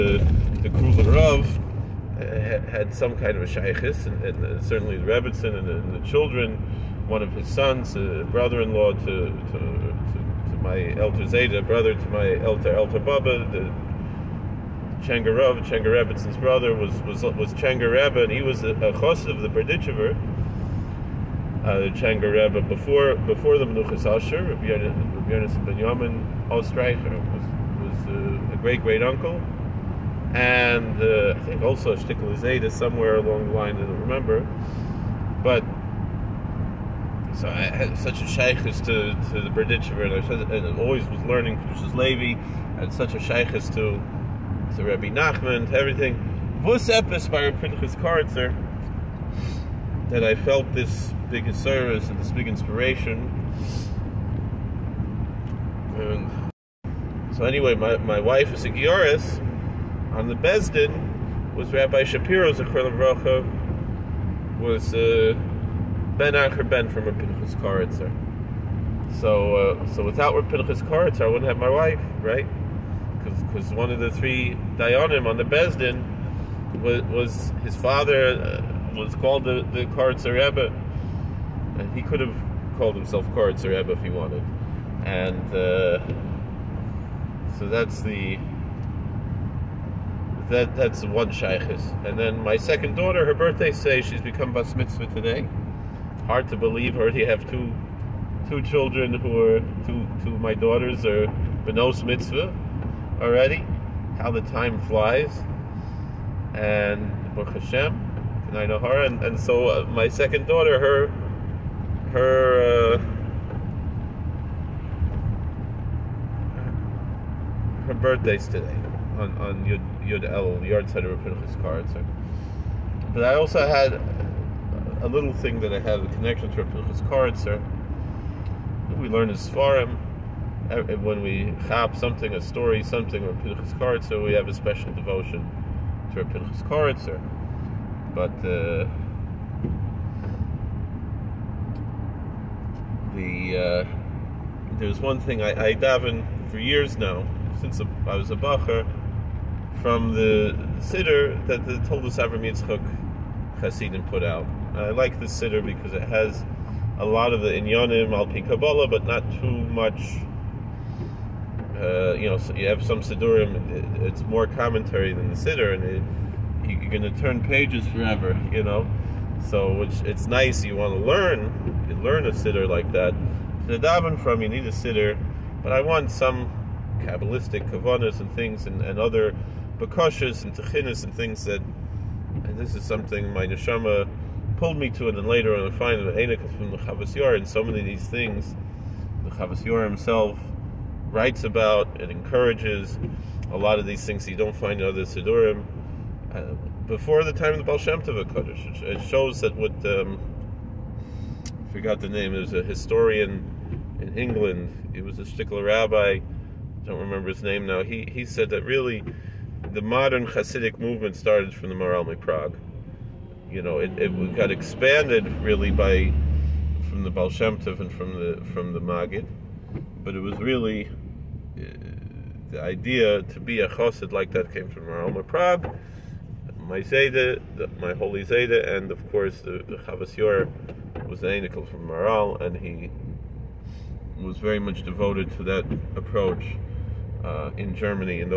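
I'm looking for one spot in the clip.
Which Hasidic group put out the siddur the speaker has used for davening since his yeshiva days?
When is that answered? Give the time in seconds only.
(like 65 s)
151 s.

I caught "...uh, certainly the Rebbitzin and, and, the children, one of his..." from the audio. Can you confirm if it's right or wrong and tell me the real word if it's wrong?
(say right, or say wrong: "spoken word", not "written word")
right.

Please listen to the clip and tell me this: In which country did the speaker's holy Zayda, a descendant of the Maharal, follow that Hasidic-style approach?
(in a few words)
Germany.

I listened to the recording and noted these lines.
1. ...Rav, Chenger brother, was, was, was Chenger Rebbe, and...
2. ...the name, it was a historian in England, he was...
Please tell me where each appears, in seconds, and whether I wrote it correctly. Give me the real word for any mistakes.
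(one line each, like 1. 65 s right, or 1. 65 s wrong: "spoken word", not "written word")
1. 15 s right
2. 201 s right.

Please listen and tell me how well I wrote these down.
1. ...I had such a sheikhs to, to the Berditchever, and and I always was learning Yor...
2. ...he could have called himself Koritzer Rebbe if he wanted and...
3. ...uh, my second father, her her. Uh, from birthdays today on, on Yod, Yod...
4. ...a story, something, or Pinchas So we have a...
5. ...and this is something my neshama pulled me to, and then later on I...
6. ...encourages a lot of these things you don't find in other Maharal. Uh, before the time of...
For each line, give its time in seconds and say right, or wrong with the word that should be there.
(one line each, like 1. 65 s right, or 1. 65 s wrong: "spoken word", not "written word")
1. 37 s wrong: "Kedushas", not "Yor"
2. 81 s right
3. 109 s wrong: "daughter", not "father"
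4. 132 s right
5. 182 s right
6. 192 s wrong: "Siddurim", not "Maharal".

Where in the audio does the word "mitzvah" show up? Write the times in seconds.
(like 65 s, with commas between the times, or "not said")
94 s, 102 s.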